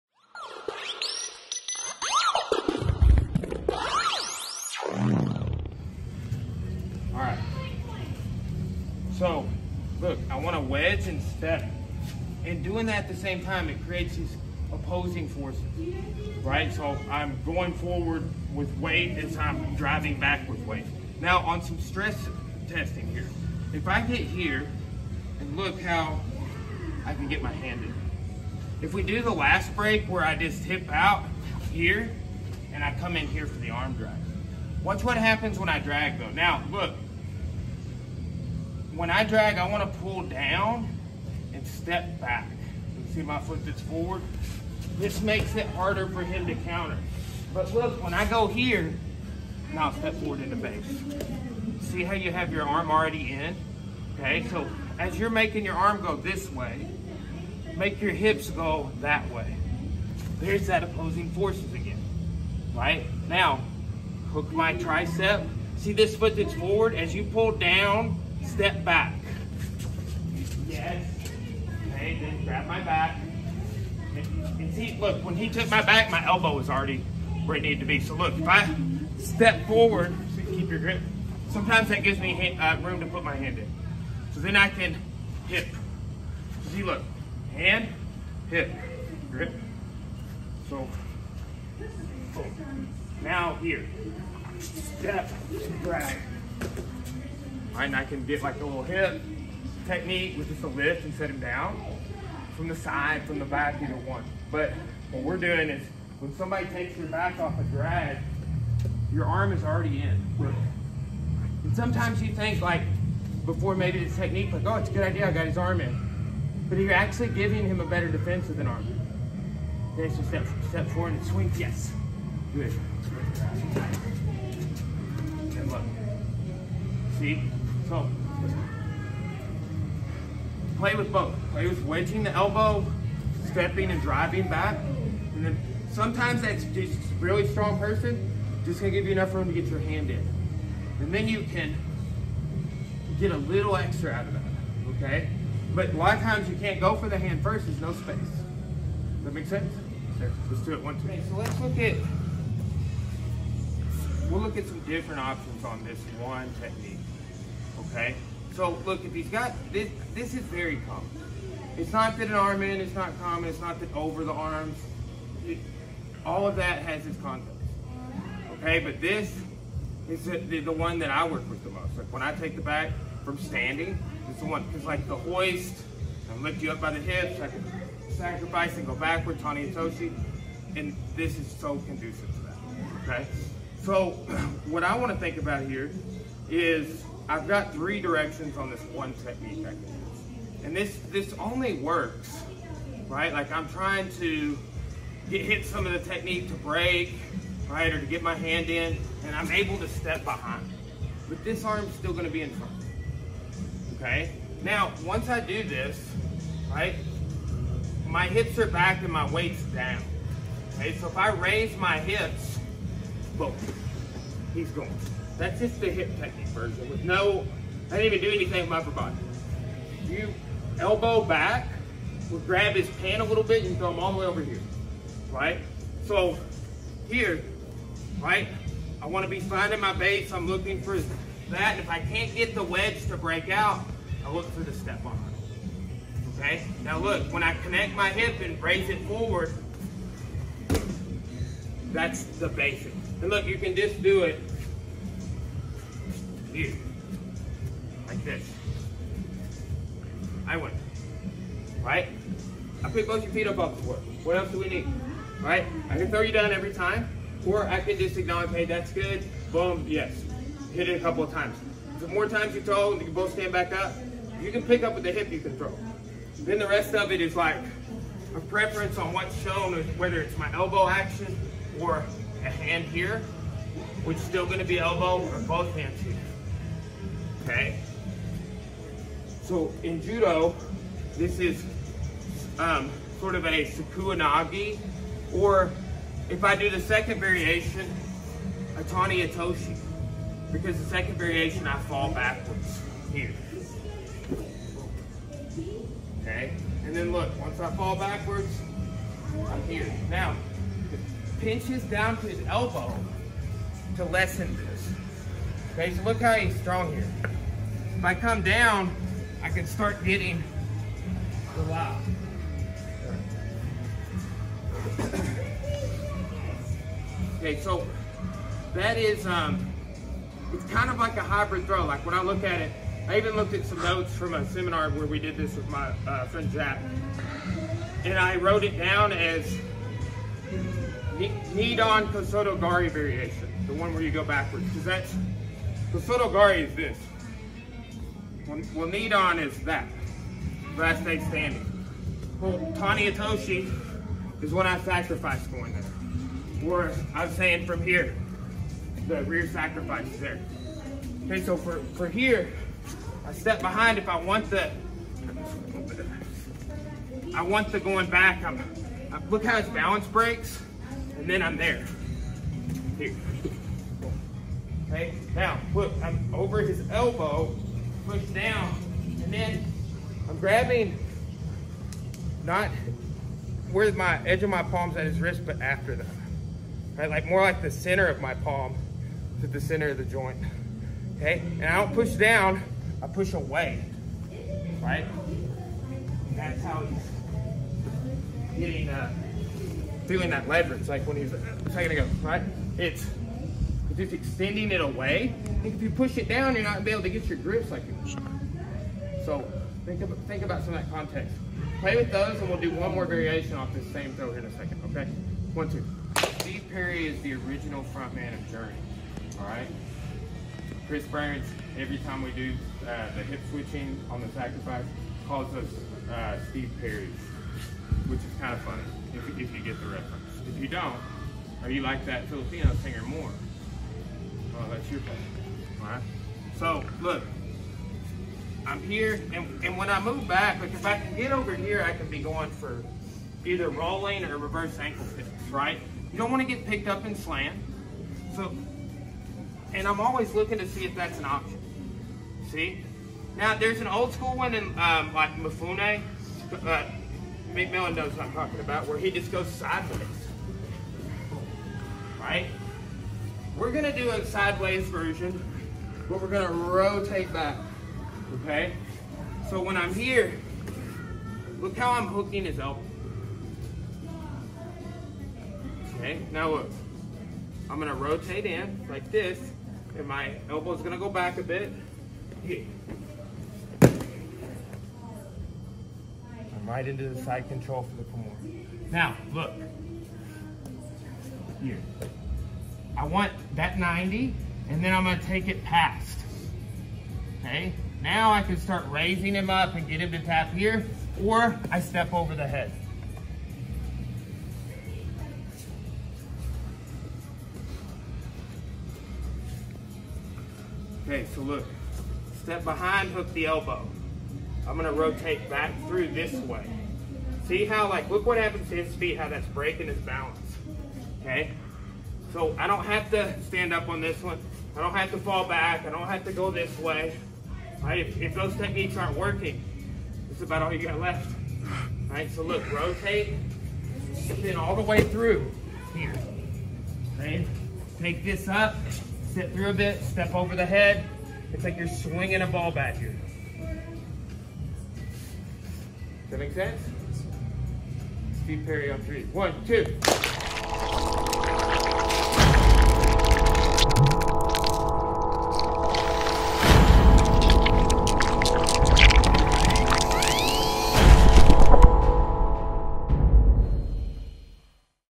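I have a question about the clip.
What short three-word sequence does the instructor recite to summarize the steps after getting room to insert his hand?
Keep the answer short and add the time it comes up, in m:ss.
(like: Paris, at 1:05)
Hand, hip, grip, at 1:27.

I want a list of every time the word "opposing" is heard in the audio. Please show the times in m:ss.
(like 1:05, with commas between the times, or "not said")
0:14, 1:00.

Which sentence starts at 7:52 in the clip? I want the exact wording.
I'm right into the side control for the corner.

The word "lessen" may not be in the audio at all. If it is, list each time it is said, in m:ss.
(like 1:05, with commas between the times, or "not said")
5:04.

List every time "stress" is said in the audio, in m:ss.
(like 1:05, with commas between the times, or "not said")
0:21.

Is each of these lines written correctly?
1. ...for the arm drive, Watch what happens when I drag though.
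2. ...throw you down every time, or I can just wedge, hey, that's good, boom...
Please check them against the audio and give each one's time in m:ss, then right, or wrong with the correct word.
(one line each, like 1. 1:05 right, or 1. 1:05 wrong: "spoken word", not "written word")
1. 0:33 right
2. 4:16 wrong: "acknowledge", not "wedge".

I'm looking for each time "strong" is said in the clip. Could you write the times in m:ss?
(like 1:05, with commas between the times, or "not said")
2:17, 5:06.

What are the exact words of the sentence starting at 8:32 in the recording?
So I don't have to stand up on this one.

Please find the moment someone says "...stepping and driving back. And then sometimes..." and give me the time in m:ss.
2:13.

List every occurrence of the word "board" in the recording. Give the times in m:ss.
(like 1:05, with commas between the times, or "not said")
4:13.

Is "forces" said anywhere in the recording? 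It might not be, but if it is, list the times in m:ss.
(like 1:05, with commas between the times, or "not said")
0:15, 1:01.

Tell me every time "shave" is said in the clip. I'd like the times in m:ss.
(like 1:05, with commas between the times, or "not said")
not said.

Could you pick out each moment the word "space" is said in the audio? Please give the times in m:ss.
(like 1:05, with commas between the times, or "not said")
2:27.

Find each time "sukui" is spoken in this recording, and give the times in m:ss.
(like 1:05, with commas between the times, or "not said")
4:43.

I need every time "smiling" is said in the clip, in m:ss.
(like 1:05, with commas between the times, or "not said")
not said.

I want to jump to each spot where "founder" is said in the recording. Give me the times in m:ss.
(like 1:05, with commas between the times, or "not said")
not said.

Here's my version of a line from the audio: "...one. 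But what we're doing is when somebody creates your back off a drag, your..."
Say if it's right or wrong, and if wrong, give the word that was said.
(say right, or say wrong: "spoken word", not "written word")
wrong: "takes", not "creates".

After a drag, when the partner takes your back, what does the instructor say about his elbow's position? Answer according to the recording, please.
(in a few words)
Already where it needed to be.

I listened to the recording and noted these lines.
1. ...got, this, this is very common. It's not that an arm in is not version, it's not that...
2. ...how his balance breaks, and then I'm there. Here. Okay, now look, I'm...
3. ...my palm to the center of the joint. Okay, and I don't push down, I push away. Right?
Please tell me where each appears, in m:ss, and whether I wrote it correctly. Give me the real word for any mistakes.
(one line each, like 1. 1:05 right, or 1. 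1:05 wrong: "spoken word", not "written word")
1. 2:39 wrong: "common", not "version"
2. 5:59 right
3. 6:18 right.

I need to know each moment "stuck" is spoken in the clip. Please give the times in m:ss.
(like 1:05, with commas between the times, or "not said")
not said.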